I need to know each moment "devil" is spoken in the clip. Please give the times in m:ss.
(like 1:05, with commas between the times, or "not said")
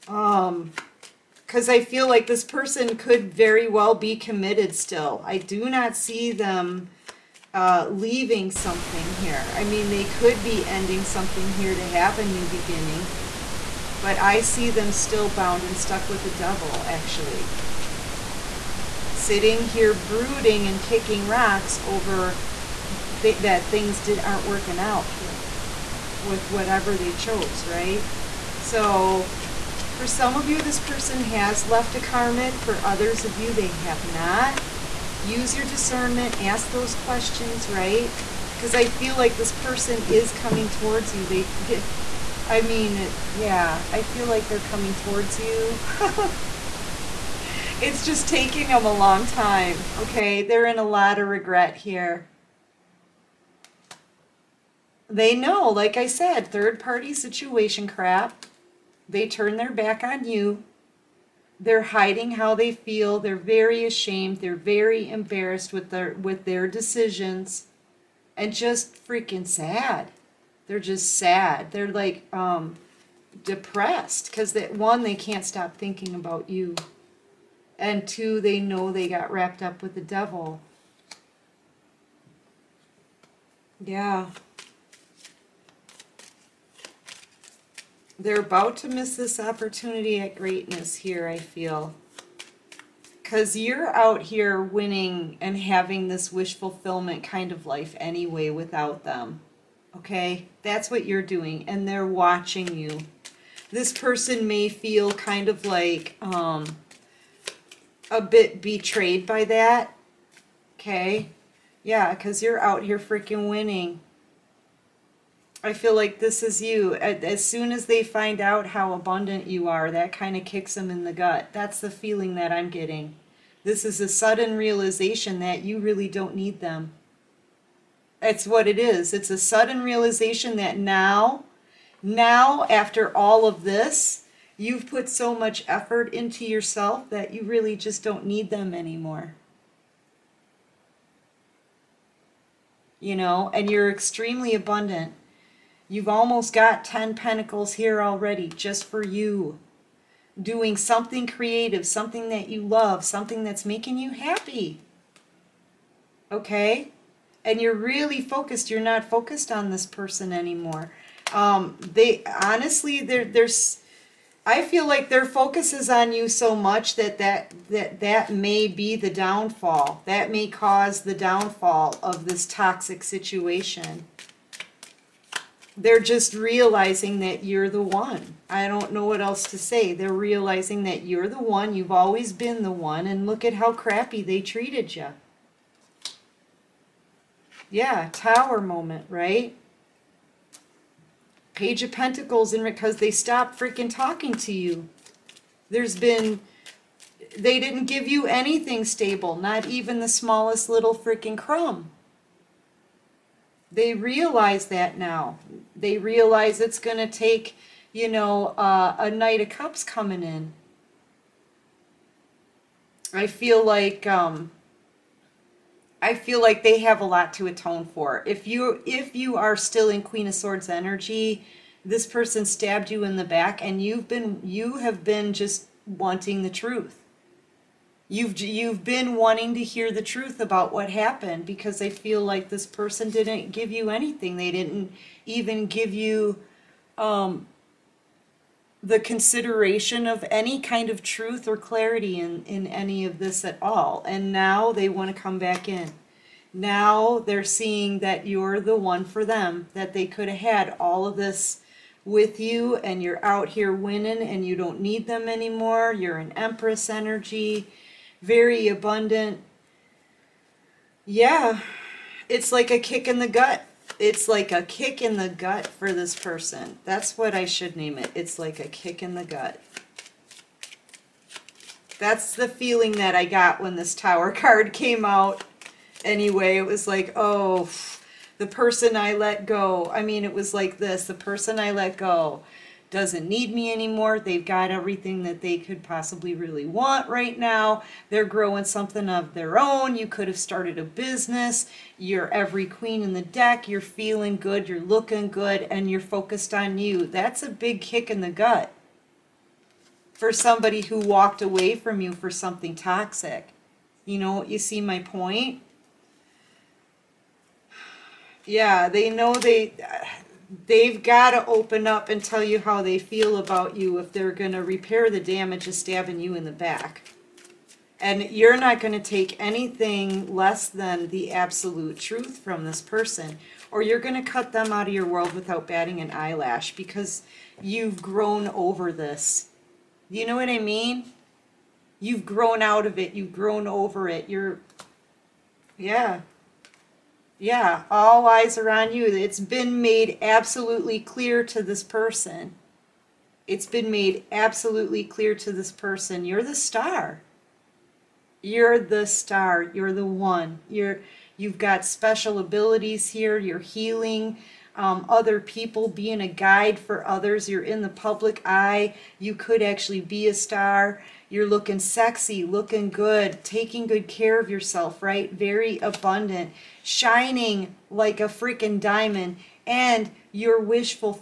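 0:16, 1:19.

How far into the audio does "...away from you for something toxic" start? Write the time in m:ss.
5:01.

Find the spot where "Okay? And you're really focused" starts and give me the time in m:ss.
2:36.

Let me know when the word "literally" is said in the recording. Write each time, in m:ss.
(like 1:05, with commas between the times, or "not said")
not said.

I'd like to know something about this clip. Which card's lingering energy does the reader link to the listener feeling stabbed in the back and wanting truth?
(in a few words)
Queen of Swords.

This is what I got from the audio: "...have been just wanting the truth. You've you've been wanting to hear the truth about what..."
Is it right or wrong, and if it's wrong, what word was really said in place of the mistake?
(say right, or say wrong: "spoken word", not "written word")
right.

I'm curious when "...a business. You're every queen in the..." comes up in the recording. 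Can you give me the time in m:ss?
4:50.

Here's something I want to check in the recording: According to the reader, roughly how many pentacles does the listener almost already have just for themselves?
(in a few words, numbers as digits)
10.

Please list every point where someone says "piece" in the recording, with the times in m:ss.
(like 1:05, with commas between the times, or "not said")
not said.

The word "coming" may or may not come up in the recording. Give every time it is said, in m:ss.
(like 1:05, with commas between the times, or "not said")
0:40, 0:44, 3:29.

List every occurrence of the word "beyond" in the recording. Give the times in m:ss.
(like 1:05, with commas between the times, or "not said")
not said.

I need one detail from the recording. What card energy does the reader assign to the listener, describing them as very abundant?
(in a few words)
Empress.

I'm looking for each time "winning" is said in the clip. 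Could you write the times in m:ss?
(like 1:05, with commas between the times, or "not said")
1:34, 1:53, 4:13.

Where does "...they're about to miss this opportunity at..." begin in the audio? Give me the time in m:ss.
1:28.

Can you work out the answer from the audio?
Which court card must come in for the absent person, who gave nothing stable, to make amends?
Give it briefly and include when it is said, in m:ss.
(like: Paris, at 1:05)
Knight of Cups, at 3:29.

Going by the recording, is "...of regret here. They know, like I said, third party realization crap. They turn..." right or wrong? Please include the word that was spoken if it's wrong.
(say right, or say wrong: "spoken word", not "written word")
wrong: "situation", not "realization".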